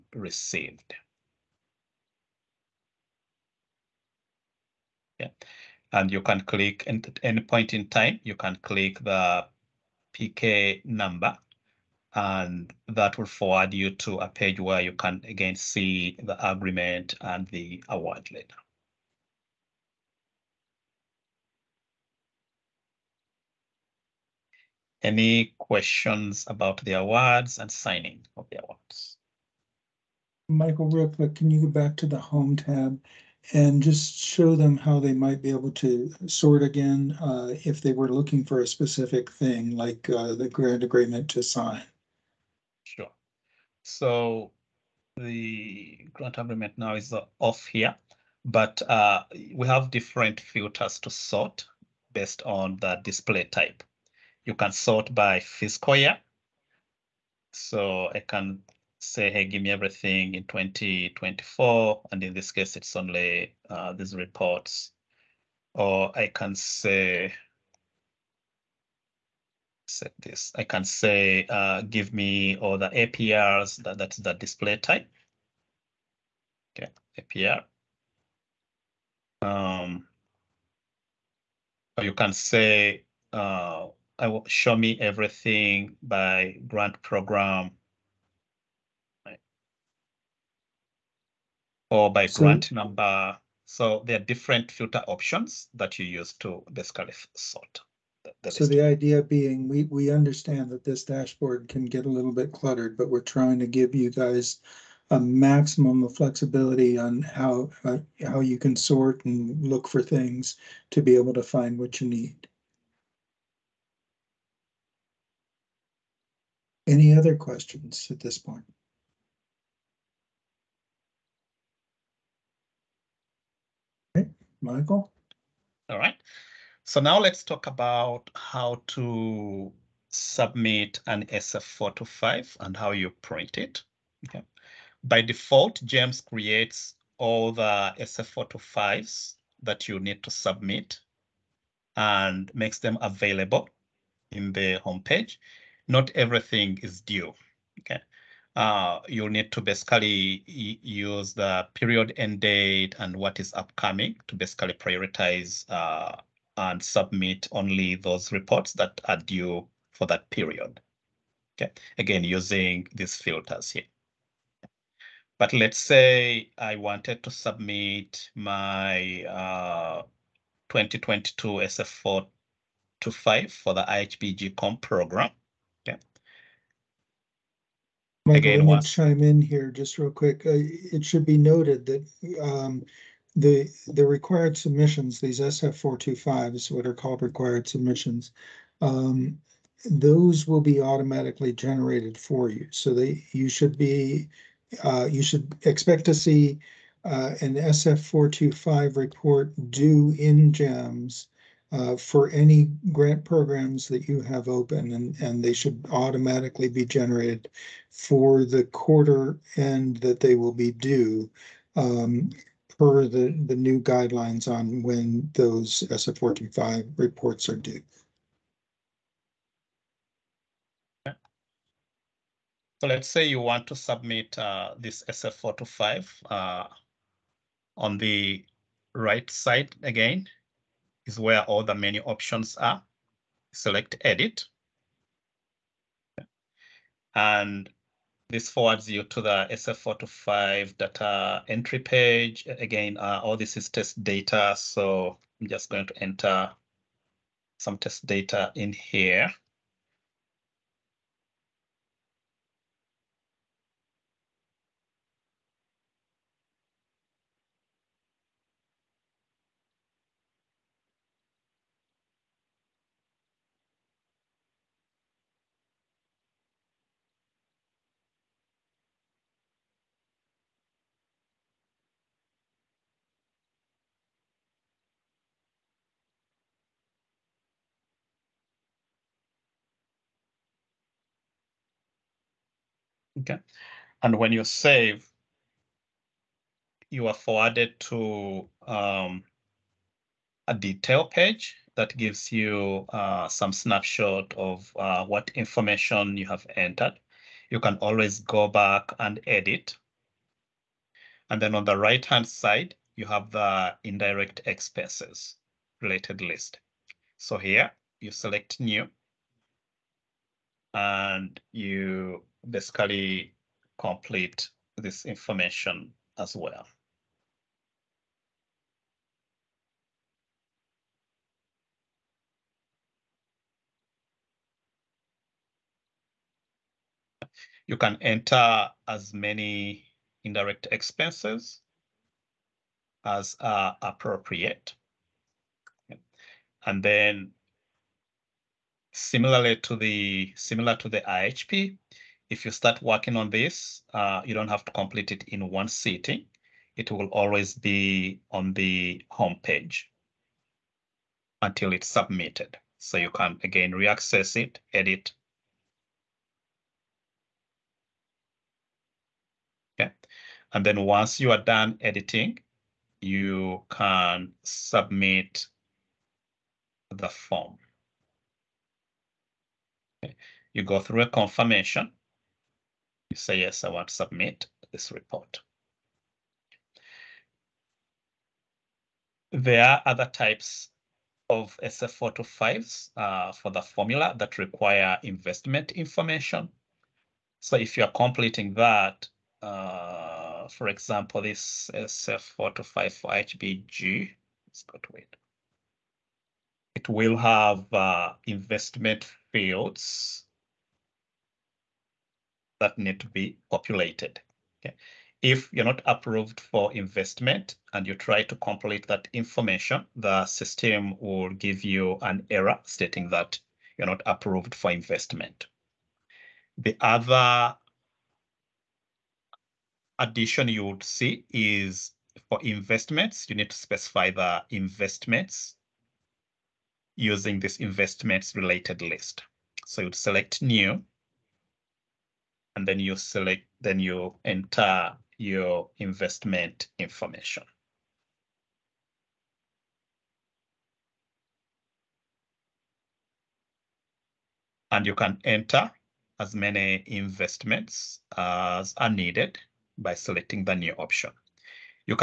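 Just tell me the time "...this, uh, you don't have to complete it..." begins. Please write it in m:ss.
5:43.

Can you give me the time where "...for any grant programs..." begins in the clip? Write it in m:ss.
3:21.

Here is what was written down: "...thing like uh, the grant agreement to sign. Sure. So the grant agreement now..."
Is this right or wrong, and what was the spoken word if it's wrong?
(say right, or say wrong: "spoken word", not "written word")
right.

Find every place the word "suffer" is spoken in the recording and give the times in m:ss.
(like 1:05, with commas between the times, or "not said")
not said.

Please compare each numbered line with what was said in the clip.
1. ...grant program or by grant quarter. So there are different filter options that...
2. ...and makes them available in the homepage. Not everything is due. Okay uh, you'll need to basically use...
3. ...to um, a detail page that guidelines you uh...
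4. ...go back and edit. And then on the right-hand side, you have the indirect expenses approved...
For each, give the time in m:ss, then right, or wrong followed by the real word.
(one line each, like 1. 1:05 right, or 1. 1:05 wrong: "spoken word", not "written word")
1. 1:26 wrong: "number", not "quarter"
2. 2:21 right
3. 4:47 wrong: "gives", not "guidelines"
4. 4:58 wrong: "related", not "approved".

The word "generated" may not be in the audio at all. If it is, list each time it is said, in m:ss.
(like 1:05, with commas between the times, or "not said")
3:11, 3:26.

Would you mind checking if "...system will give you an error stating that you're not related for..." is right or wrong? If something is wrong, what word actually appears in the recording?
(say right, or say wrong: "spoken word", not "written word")
wrong: "approved", not "related".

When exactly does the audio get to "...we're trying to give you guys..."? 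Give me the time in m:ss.
1:43.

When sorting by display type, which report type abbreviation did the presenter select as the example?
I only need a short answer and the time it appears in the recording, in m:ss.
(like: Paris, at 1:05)
APR, at 1:17.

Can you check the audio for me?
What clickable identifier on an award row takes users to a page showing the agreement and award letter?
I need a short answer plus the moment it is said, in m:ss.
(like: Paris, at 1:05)
PK number, at 0:10.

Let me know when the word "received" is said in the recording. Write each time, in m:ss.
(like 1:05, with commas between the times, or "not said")
0:00.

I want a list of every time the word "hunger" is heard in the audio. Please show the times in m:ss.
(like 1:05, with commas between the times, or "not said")
not said.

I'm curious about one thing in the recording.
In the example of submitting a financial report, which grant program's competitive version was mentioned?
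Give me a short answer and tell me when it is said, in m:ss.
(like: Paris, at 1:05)
IHBG comp, at 2:53.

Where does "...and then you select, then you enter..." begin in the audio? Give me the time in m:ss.
7:12.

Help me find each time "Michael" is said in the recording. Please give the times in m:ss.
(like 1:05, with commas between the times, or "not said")
0:30, 2:04, 2:58.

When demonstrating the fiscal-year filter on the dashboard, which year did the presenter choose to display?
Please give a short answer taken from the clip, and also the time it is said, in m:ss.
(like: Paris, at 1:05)
2024, at 1:00.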